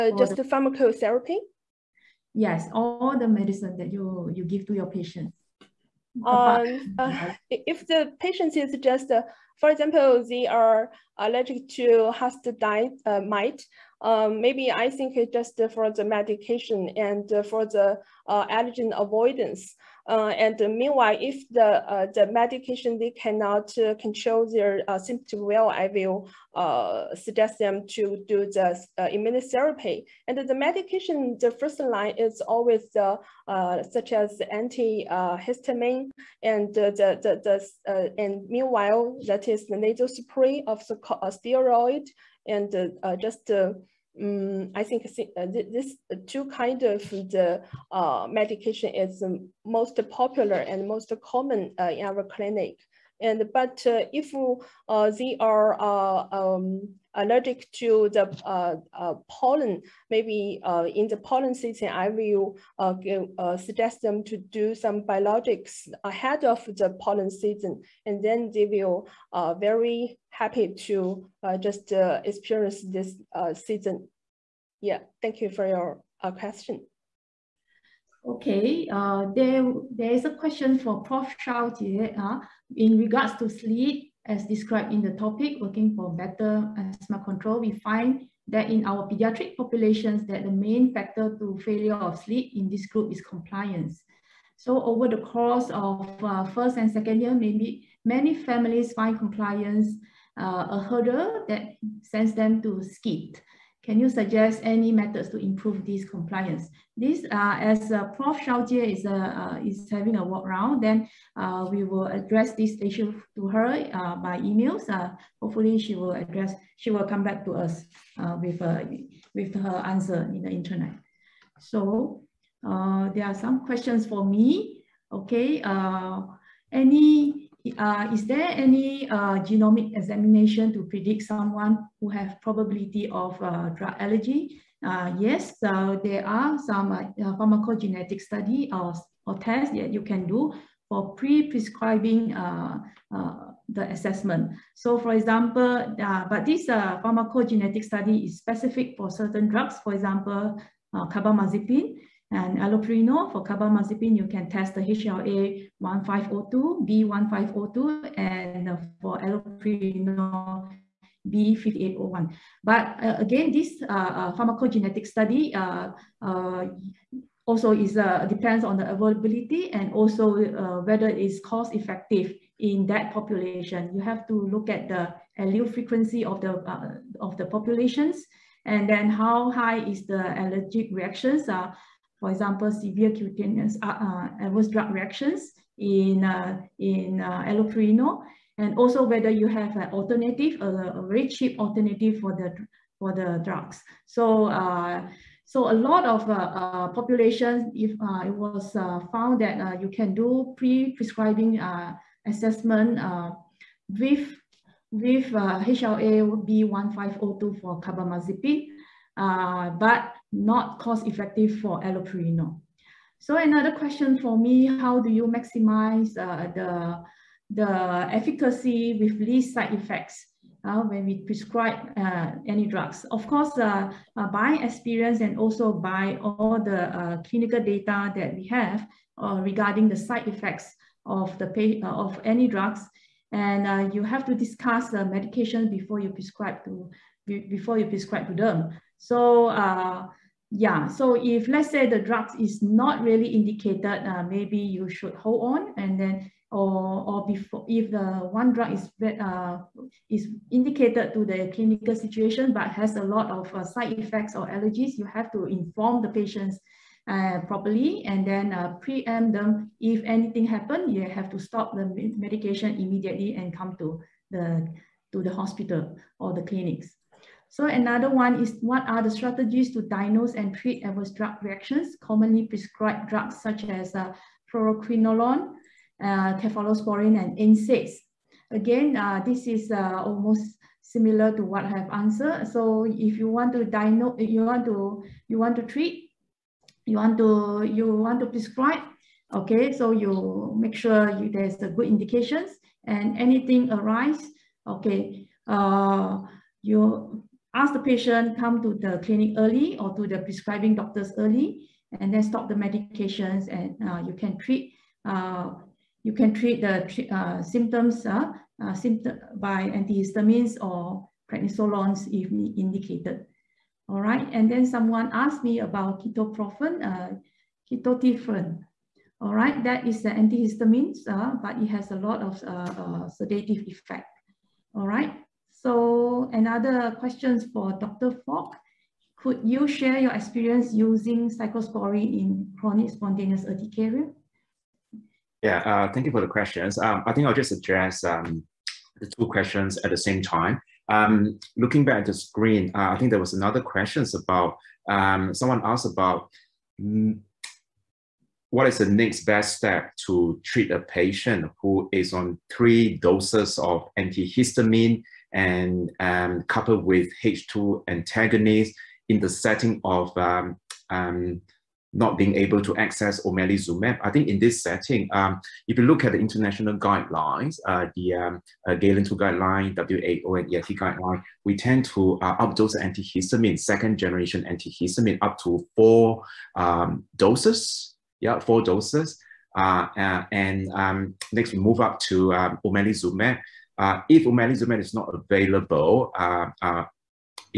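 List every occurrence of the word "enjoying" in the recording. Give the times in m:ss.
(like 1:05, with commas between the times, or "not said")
not said.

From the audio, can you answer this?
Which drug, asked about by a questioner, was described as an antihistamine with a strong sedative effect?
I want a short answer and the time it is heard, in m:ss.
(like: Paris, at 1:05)
ketotifen, at 5:17.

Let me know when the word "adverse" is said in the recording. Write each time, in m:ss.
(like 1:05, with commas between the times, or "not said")
3:03, 4:30.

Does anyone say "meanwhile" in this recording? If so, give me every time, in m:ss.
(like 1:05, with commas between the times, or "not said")
0:20, 0:38.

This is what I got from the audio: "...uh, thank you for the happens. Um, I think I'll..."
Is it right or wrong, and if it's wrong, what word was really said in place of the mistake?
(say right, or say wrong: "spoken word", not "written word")
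wrong: "questions", not "happens".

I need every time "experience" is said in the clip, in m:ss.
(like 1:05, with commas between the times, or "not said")
1:11, 3:44, 5:30.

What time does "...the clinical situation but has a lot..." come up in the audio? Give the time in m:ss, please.
4:11.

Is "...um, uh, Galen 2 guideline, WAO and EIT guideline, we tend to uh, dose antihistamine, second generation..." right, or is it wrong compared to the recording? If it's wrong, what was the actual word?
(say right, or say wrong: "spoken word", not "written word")
right.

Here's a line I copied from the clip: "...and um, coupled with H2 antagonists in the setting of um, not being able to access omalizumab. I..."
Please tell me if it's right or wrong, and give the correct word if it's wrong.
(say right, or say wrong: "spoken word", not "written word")
right.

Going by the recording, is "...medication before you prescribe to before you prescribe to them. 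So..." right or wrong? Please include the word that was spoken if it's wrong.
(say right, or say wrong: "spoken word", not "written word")
right.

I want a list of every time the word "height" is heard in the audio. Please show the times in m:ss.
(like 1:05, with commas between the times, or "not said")
not said.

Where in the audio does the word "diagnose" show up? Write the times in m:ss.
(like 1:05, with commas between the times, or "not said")
4:29, 4:43.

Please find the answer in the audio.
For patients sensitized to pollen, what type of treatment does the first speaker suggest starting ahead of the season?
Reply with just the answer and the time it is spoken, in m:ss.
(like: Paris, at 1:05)
biologics, at 1:05.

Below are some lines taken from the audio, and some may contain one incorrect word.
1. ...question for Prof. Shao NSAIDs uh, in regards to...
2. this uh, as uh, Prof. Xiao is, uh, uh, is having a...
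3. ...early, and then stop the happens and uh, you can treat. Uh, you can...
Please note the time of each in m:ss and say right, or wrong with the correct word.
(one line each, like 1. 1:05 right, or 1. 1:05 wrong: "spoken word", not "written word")
1. 1:20 wrong: "Jie", not "NSAIDs"
2. 1:46 right
3. 5:01 wrong: "medications", not "happens".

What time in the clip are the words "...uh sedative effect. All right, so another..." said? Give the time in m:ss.
5:22.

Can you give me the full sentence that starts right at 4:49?
Okay, so you make sure you, there's a good indications and anything arise.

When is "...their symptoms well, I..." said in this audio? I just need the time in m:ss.
0:24.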